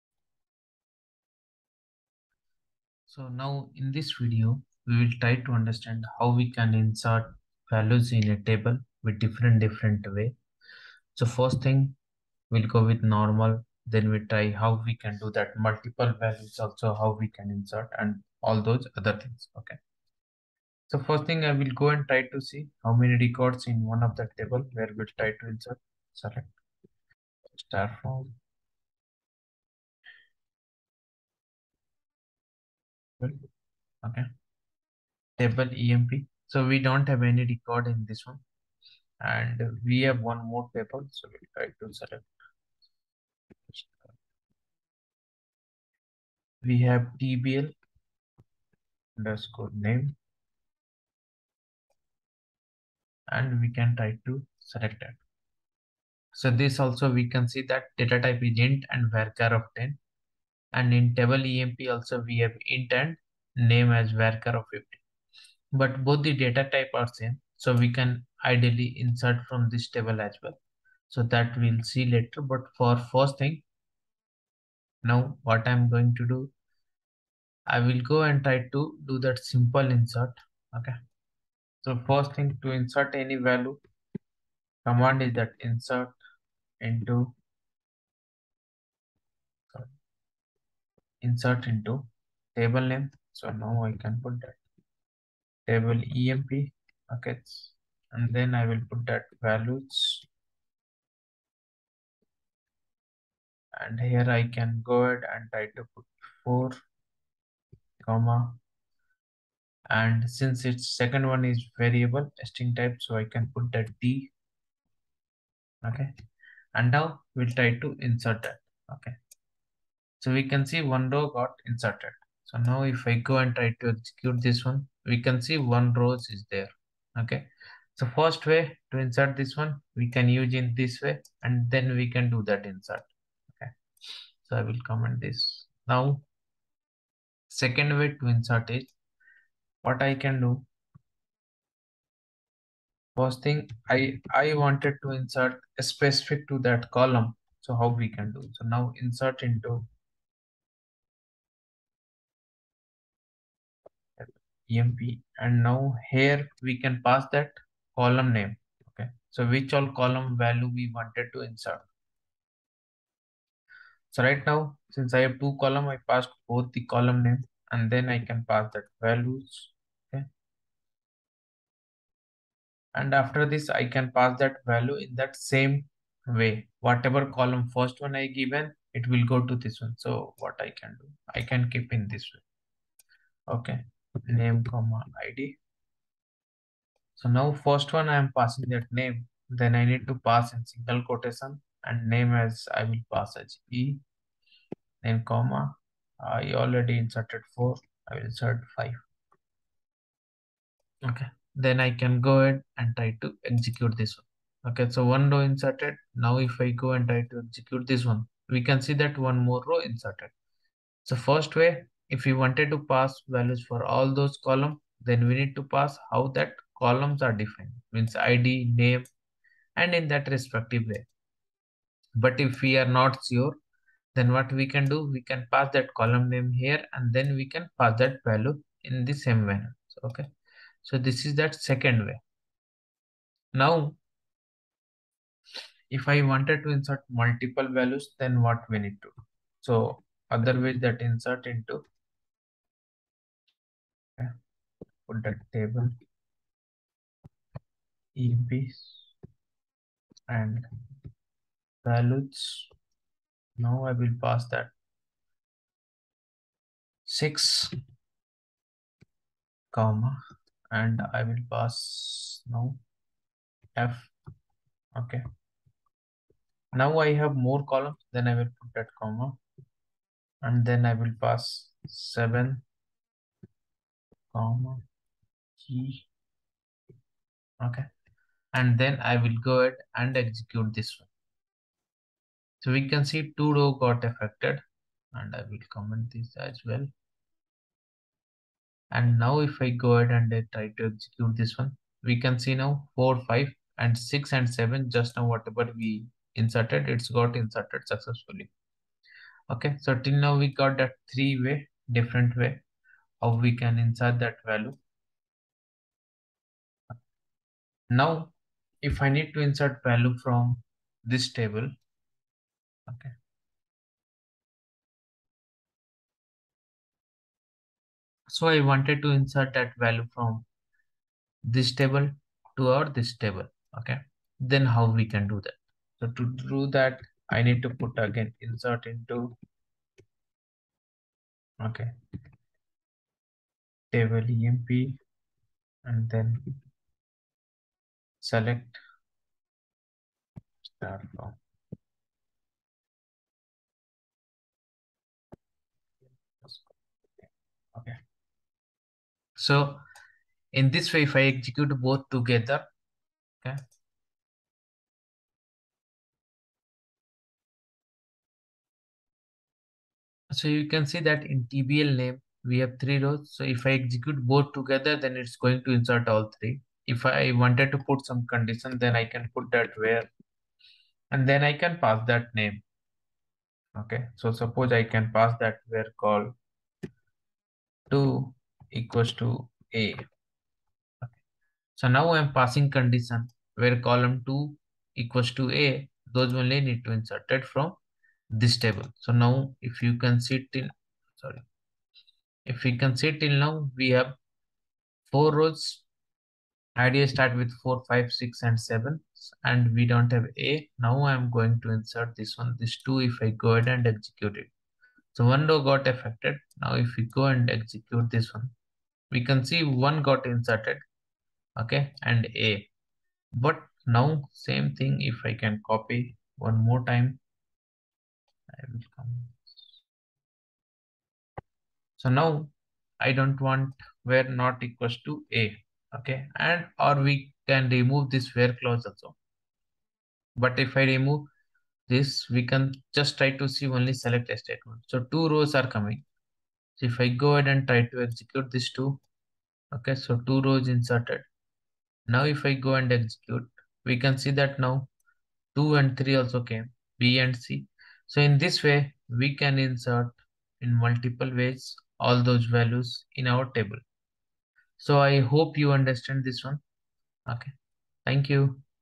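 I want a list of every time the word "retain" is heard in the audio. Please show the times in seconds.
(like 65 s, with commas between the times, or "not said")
not said.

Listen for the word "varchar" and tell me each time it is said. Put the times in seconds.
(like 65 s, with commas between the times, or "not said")
59 s, 64 s.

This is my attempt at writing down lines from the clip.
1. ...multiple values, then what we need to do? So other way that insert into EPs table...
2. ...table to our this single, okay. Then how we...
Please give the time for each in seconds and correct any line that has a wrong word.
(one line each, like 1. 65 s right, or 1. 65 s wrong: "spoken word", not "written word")
1. 237 s wrong: "Product", not "EPs"
2. 321 s wrong: "table", not "single".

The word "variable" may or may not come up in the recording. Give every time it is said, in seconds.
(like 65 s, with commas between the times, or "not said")
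111 s.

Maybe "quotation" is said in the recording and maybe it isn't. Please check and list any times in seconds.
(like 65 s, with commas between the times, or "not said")
191 s.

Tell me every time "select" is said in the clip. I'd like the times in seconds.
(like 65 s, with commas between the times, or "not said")
26 s, 41 s, 54 s, 338 s, 433 s.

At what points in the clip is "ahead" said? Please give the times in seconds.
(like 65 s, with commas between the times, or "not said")
105 s, 202 s, 279 s, 289 s, 403 s, 437 s.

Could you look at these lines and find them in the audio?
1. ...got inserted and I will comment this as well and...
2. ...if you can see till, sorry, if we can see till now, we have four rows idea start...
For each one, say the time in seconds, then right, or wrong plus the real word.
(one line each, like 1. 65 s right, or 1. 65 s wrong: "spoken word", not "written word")
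1. 283 s wrong: "affected", not "inserted"
2. 389 s right.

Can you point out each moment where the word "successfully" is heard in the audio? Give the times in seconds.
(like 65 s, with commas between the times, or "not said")
297 s.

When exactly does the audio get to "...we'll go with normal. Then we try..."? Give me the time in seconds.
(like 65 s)
12 s.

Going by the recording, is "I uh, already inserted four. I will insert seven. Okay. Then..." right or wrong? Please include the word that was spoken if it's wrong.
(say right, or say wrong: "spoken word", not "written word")
wrong: "five", not "seven".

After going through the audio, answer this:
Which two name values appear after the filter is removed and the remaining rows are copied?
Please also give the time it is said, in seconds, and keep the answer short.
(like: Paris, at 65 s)
B and C, at 446 s.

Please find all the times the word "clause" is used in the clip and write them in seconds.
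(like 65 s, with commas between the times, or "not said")
428 s.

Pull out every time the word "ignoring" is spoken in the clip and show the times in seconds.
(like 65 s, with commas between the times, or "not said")
not said.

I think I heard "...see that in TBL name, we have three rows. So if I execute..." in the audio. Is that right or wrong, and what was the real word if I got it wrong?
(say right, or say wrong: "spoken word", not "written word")
right.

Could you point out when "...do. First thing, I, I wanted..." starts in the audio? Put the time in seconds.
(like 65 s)
140 s.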